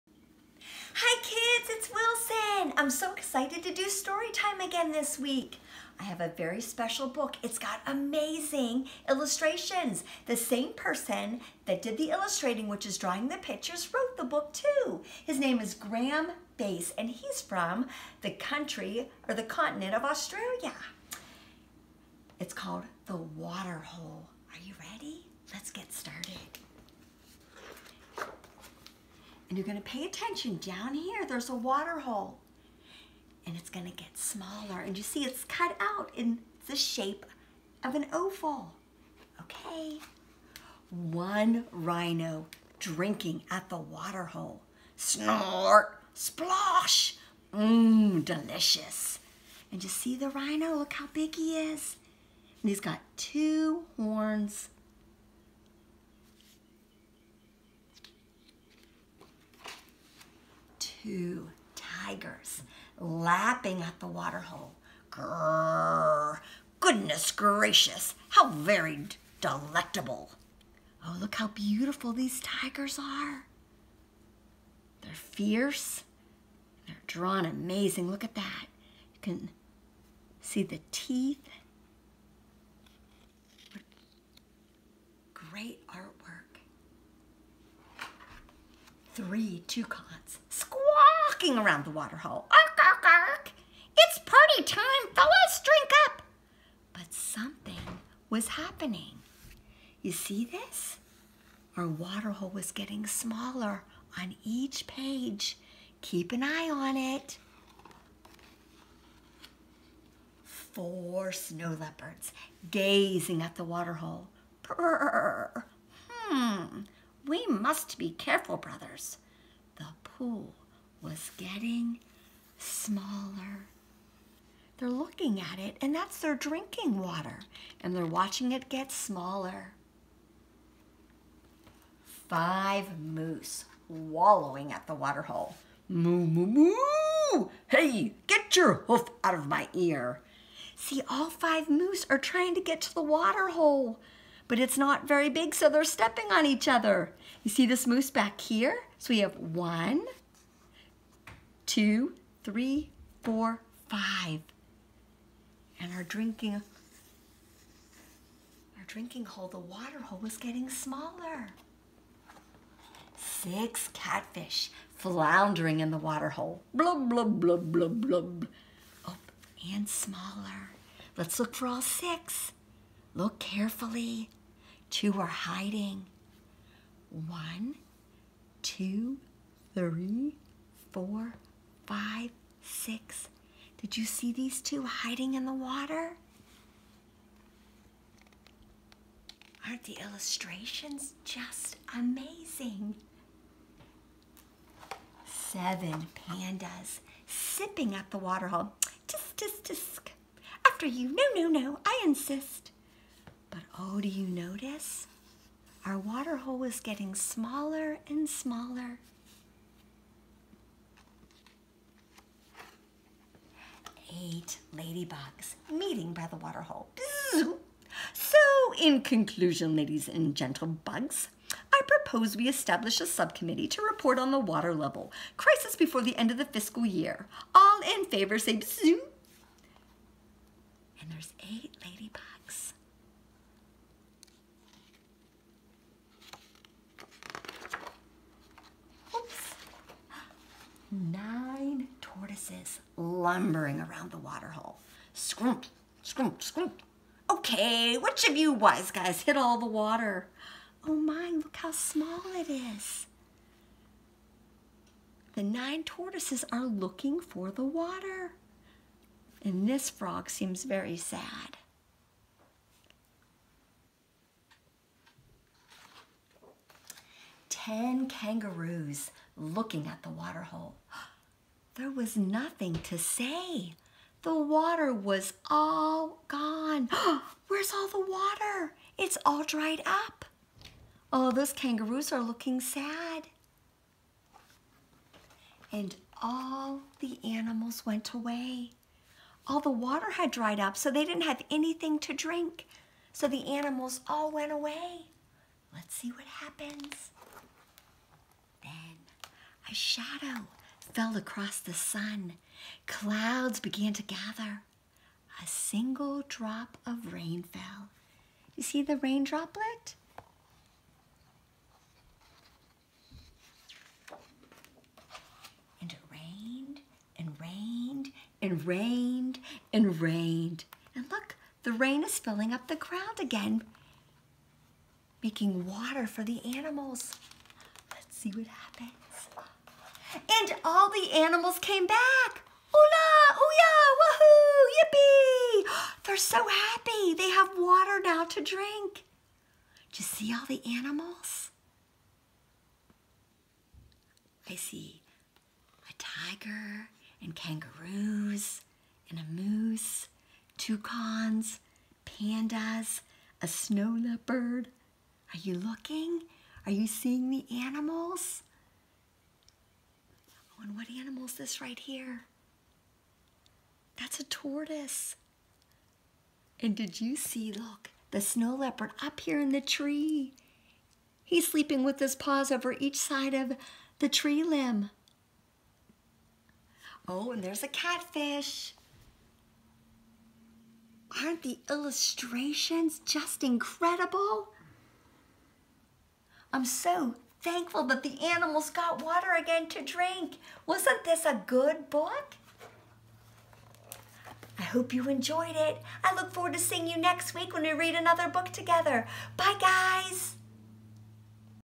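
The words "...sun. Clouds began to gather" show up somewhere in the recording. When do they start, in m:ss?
5:01.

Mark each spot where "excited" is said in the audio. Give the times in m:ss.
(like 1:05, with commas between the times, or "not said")
0:03.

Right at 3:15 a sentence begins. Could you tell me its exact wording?
Seven pandas sipping at the waterhole.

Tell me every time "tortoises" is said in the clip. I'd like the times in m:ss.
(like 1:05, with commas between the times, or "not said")
4:15, 6:04.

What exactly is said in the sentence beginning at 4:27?
Ten kangaroos looking at the waterhole.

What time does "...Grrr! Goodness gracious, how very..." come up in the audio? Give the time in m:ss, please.
1:05.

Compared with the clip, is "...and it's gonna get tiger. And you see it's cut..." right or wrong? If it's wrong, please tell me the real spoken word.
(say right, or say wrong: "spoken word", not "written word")
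wrong: "smaller", not "tiger".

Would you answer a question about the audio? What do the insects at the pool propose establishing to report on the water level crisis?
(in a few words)
A subcommittee.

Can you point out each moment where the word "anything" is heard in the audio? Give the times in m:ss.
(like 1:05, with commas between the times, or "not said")
4:51.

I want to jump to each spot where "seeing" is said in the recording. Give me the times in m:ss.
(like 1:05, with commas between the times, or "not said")
5:56, 6:36.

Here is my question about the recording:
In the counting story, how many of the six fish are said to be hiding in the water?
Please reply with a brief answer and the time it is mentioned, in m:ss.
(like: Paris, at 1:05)
2, at 2:54.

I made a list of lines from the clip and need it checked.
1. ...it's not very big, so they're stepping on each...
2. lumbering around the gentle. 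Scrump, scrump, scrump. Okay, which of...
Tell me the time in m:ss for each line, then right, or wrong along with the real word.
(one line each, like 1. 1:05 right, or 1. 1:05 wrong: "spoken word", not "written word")
1. 2:24 right
2. 4:02 wrong: "waterhole", not "gentle".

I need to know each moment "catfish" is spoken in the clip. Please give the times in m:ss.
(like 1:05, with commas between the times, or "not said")
2:43, 6:17.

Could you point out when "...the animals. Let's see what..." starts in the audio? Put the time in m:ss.
5:26.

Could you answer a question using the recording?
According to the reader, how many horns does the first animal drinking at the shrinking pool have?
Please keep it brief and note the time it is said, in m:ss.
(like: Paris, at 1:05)
2, at 0:53.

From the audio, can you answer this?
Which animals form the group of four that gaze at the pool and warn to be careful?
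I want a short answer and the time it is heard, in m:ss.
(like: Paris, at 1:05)
Snow leopards, at 1:51.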